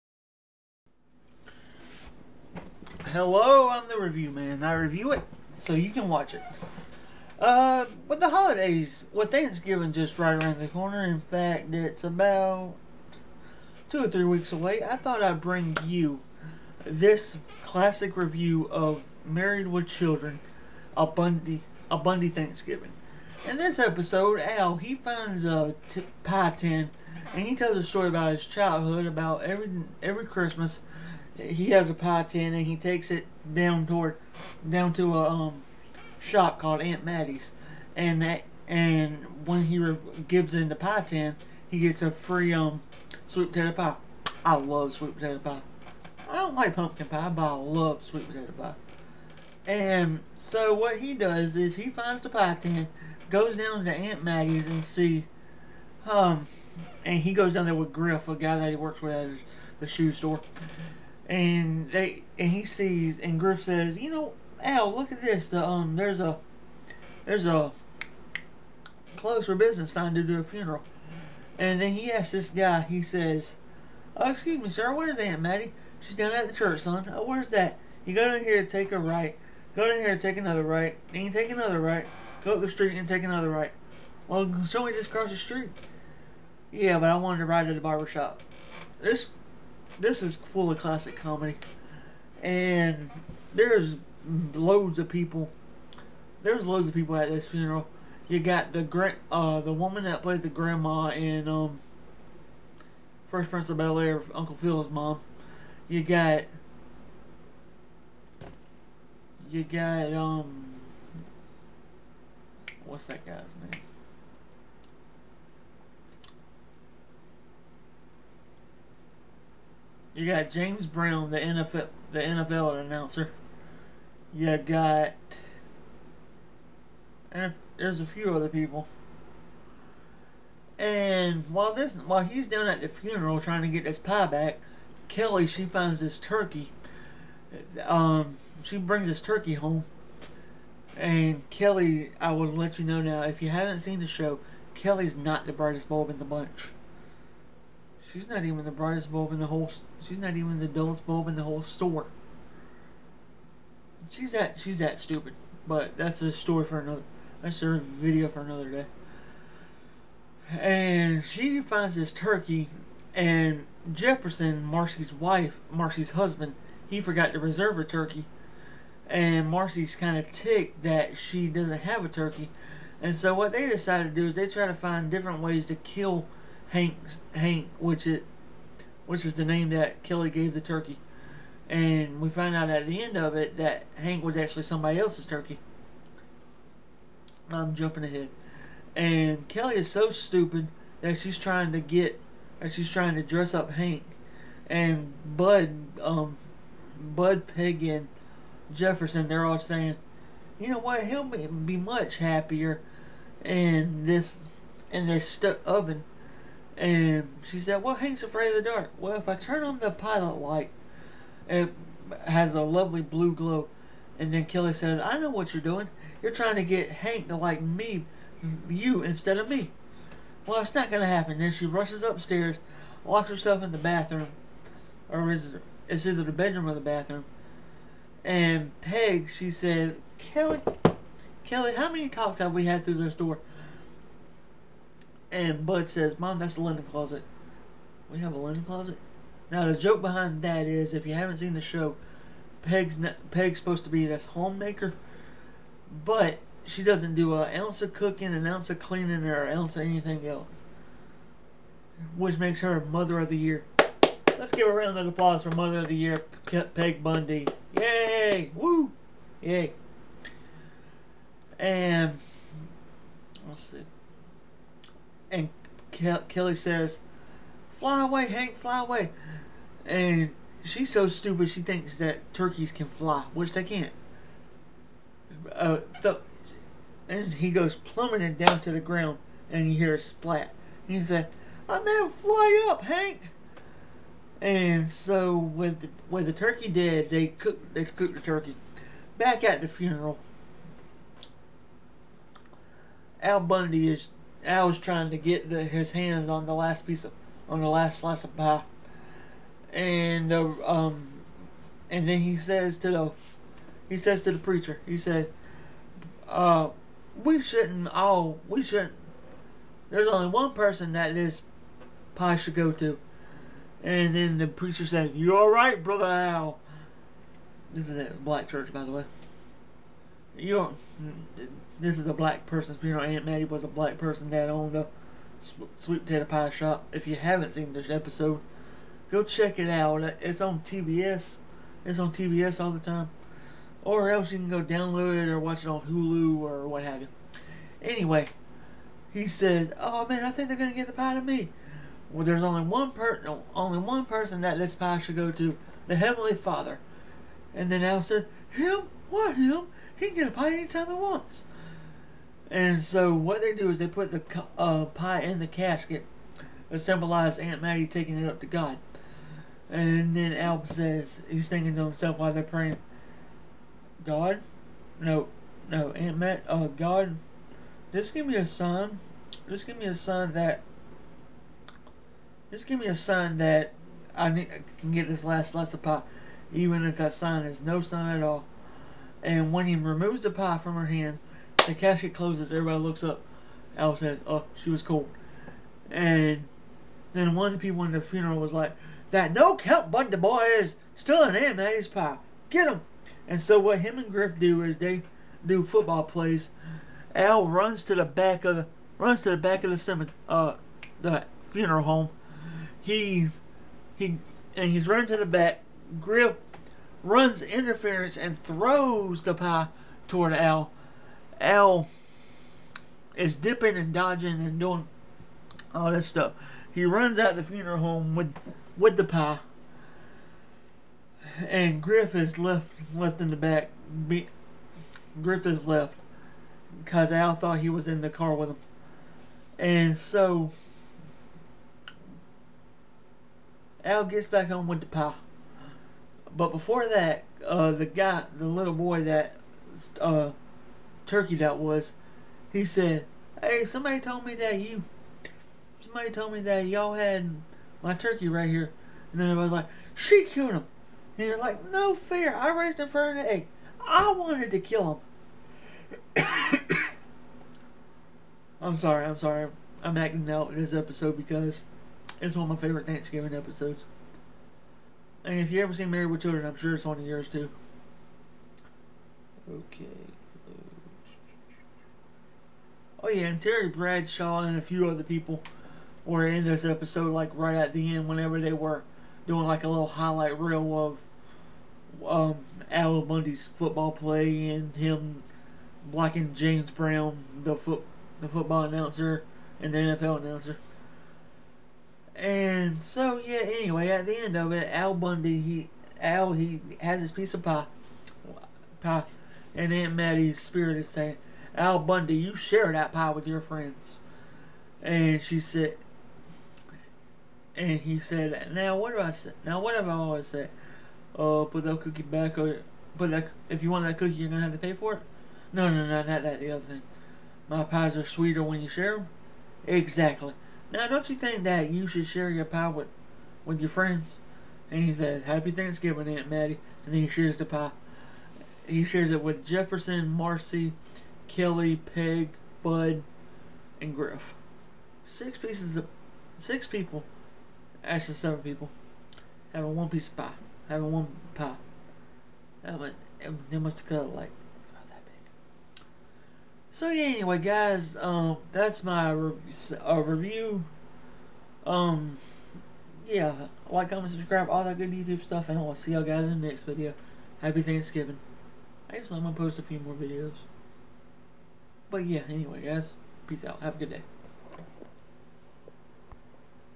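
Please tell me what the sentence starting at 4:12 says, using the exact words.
Which makes her Mother of the Year.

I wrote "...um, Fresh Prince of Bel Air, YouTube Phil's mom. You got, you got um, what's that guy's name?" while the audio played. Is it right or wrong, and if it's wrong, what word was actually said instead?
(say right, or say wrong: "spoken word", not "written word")
wrong: "Uncle", not "YouTube".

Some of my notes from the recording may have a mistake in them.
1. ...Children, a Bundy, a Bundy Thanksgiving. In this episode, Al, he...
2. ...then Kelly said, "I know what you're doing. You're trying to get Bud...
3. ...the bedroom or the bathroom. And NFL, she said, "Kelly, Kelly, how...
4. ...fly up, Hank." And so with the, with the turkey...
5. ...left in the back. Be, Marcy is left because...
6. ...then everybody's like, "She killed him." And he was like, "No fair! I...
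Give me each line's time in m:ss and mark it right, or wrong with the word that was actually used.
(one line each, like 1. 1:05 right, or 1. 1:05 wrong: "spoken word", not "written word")
1. 0:19 right
2. 3:34 wrong: "Hank", not "Bud"
3. 3:46 wrong: "Peg", not "NFL"
4. 4:42 right
5. 7:02 wrong: "Griff", not "Marcy"
6. 7:29 right.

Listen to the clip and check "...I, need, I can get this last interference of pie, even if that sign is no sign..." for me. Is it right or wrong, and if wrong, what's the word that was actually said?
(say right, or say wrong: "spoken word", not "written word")
wrong: "slice", not "interference".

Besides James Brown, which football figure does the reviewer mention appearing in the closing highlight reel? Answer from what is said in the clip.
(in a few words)
Terry Bradshaw.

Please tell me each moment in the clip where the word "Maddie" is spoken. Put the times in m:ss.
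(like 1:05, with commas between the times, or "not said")
0:37, 0:54, 1:15, 5:23, 8:46.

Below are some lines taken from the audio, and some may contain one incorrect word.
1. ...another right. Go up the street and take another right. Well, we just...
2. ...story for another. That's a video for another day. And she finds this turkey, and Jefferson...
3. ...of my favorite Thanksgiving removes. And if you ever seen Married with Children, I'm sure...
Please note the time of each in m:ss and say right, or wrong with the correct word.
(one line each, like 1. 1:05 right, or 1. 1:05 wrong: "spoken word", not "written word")
1. 1:21 right
2. 2:36 right
3. 7:42 wrong: "episodes", not "removes".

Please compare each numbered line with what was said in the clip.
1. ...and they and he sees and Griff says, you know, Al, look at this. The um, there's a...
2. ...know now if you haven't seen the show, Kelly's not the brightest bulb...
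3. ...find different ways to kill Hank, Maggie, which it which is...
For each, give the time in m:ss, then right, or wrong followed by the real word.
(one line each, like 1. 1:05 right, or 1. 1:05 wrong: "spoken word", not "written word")
1. 1:01 right
2. 2:22 right
3. 2:54 wrong: "Hank", not "Maggie".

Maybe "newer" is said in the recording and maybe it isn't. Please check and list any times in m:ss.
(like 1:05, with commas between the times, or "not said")
not said.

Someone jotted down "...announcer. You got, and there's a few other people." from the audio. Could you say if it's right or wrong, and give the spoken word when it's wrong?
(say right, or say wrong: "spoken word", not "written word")
right.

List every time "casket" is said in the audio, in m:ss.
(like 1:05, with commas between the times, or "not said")
5:55, 6:21.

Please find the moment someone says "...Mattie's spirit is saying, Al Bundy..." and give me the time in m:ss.
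8:19.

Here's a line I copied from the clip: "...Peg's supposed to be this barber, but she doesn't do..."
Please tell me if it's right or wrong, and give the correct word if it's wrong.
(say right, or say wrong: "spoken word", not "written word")
wrong: "homemaker", not "barber".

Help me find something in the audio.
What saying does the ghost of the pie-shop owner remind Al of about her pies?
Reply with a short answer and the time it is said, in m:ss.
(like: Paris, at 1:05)
my pies are sweeter when you share them, at 8:38.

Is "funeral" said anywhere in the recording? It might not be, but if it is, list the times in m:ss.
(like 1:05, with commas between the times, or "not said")
1:10, 1:37, 2:12, 4:49, 5:22, 6:28, 6:41, 6:57.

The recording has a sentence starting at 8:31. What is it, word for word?
Oh, put that cookie back, or put that.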